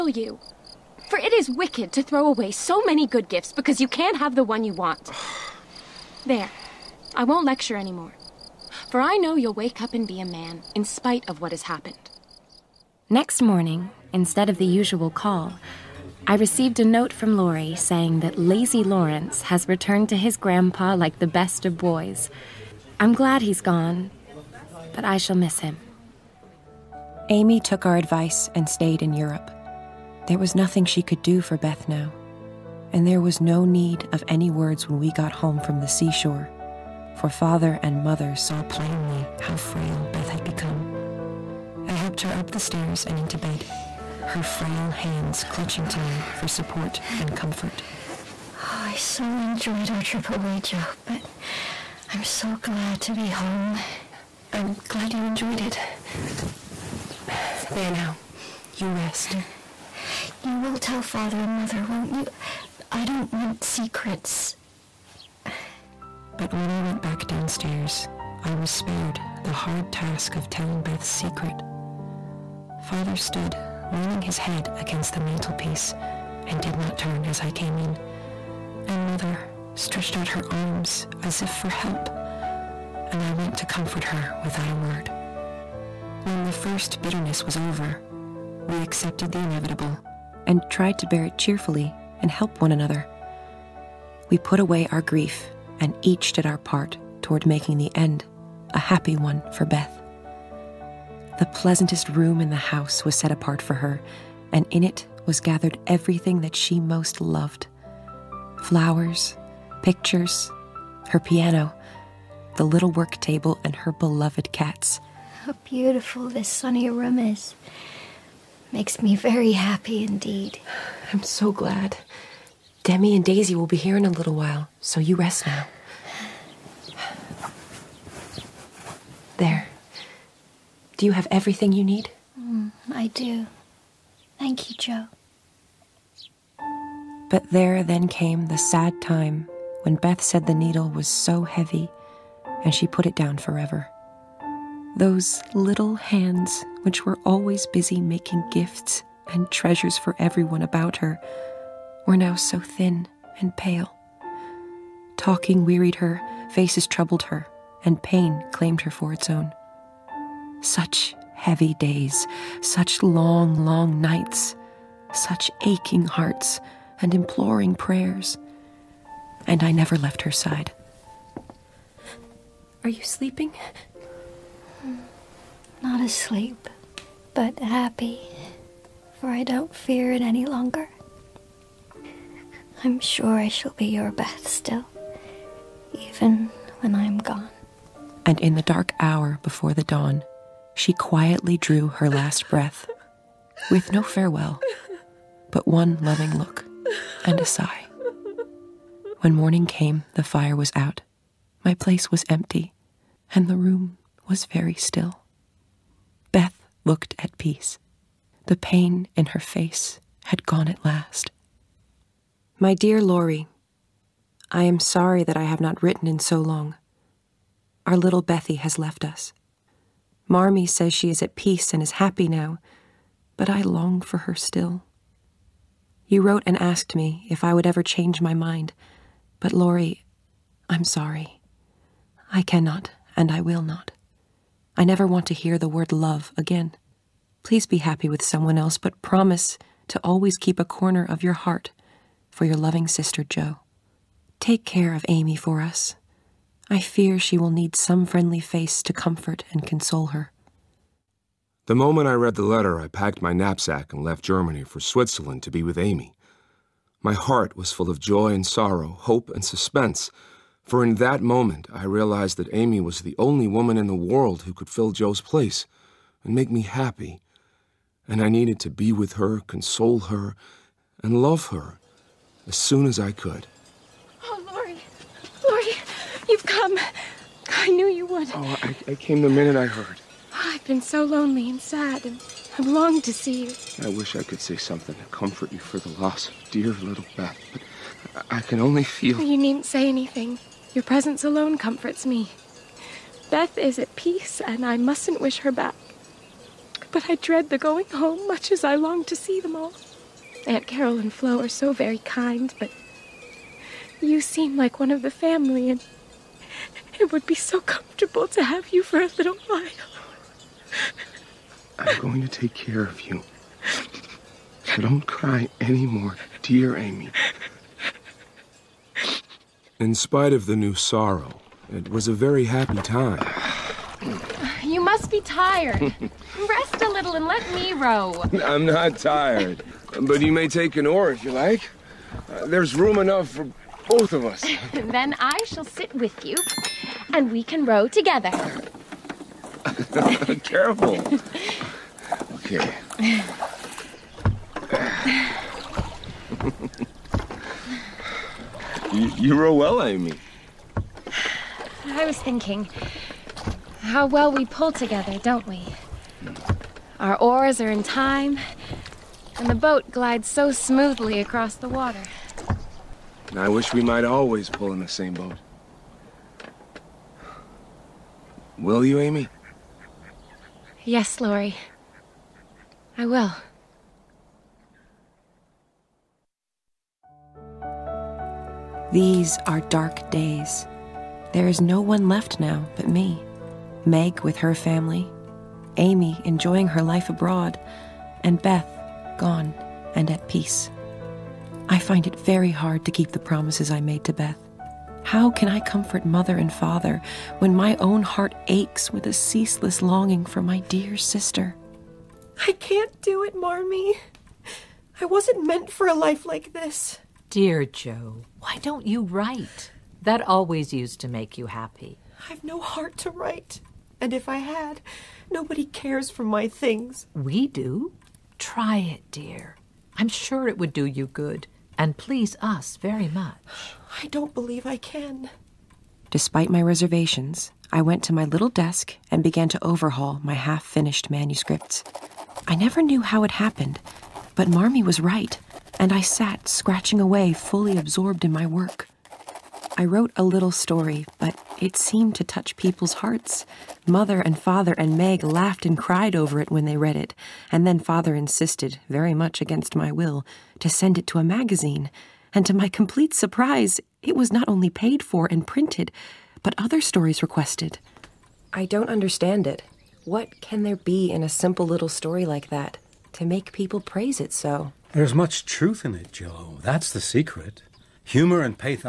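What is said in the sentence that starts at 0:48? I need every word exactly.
Oh, I so enjoyed our trip away, Jo, but I'm so glad to be home.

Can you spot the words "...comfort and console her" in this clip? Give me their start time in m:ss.
4:08.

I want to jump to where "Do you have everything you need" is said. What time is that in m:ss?
2:10.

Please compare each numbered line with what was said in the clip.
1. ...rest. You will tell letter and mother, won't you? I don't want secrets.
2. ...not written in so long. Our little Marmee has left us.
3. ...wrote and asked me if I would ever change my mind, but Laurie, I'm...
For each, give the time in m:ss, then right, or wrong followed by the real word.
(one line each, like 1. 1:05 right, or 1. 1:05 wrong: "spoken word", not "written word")
1. 0:58 wrong: "father", not "letter"
2. 3:35 wrong: "Bethy", not "Marmee"
3. 3:46 right.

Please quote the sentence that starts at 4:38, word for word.
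Oh, I, I came the minute I heard.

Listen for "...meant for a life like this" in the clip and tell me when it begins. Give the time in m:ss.
6:45.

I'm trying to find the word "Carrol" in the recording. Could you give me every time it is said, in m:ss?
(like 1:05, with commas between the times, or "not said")
5:00.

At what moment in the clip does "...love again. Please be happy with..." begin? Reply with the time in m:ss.
3:55.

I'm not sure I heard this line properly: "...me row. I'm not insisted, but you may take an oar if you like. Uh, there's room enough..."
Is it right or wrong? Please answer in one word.
wrong.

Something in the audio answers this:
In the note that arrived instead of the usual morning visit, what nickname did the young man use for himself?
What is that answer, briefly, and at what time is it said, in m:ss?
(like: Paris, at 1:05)
Lazy Lawrence, at 0:18.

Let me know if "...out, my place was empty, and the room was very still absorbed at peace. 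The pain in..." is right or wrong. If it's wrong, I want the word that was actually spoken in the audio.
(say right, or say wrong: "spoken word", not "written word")
wrong: "looked", not "absorbed".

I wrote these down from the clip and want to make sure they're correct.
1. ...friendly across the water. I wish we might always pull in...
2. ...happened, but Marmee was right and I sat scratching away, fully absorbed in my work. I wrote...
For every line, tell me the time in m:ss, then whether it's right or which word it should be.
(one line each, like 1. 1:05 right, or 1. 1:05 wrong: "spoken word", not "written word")
1. 6:00 wrong: "smoothly", not "friendly"
2. 7:13 right.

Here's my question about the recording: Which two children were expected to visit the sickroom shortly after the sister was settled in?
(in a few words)
Demi and Daisy.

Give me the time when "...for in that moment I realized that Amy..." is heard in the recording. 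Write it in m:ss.
4:20.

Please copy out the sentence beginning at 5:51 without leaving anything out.
I was thinking how well we pull together, don't we?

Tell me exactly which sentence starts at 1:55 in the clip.
How beautiful this sunny room is.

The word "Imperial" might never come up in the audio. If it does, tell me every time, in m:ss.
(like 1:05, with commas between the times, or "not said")
not said.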